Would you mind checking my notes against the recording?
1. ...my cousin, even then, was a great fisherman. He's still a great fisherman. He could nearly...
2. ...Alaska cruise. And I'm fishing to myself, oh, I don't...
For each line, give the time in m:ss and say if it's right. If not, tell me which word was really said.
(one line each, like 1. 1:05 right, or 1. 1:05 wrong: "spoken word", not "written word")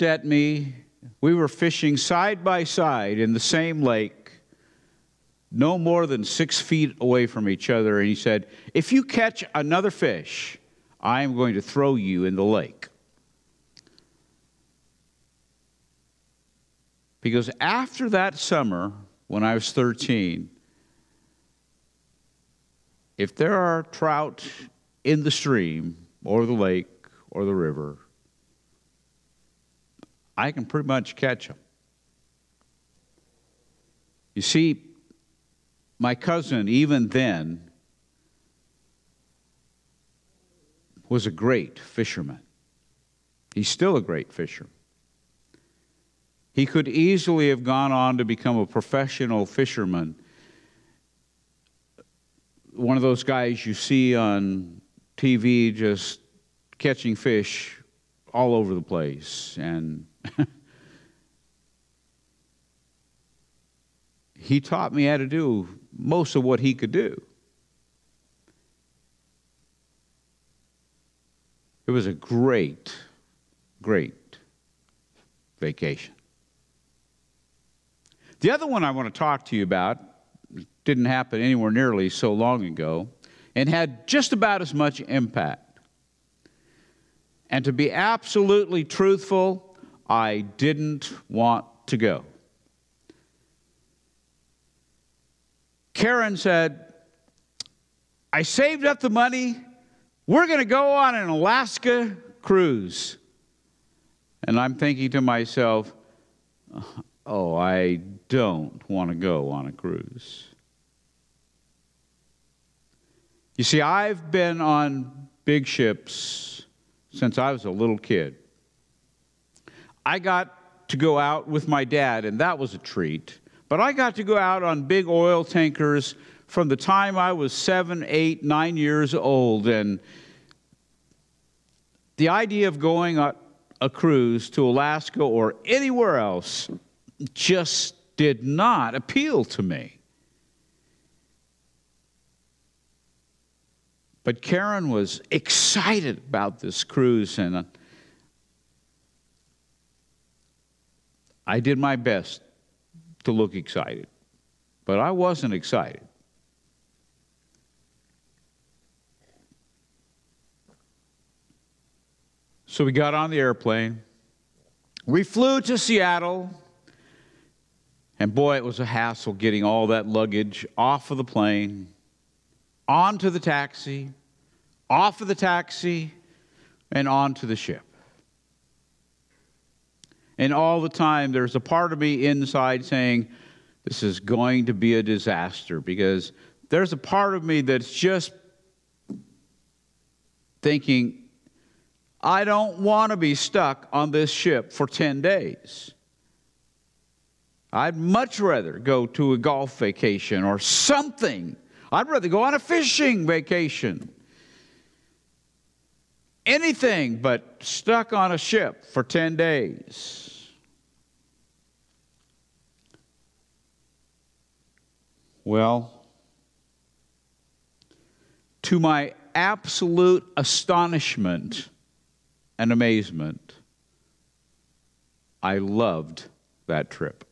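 1. 0:35 wrong: "easily", not "nearly"
2. 1:41 wrong: "thinking", not "fishing".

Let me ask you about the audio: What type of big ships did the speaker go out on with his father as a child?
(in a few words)
Oil tankers.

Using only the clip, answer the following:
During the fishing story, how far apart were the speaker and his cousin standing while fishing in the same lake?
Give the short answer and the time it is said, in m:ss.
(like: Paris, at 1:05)
6 feet, at 0:06.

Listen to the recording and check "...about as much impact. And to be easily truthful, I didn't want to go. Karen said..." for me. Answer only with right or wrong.
wrong.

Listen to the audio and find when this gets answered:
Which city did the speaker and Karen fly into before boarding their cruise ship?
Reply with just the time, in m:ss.
2:45.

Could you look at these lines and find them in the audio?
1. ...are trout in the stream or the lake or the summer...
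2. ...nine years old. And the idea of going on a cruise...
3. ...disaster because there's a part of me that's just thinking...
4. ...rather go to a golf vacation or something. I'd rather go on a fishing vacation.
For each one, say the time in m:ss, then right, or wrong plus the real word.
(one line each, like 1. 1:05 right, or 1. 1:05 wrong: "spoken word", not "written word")
1. 0:23 wrong: "river", not "summer"
2. 2:08 right
3. 3:05 right
4. 3:18 right.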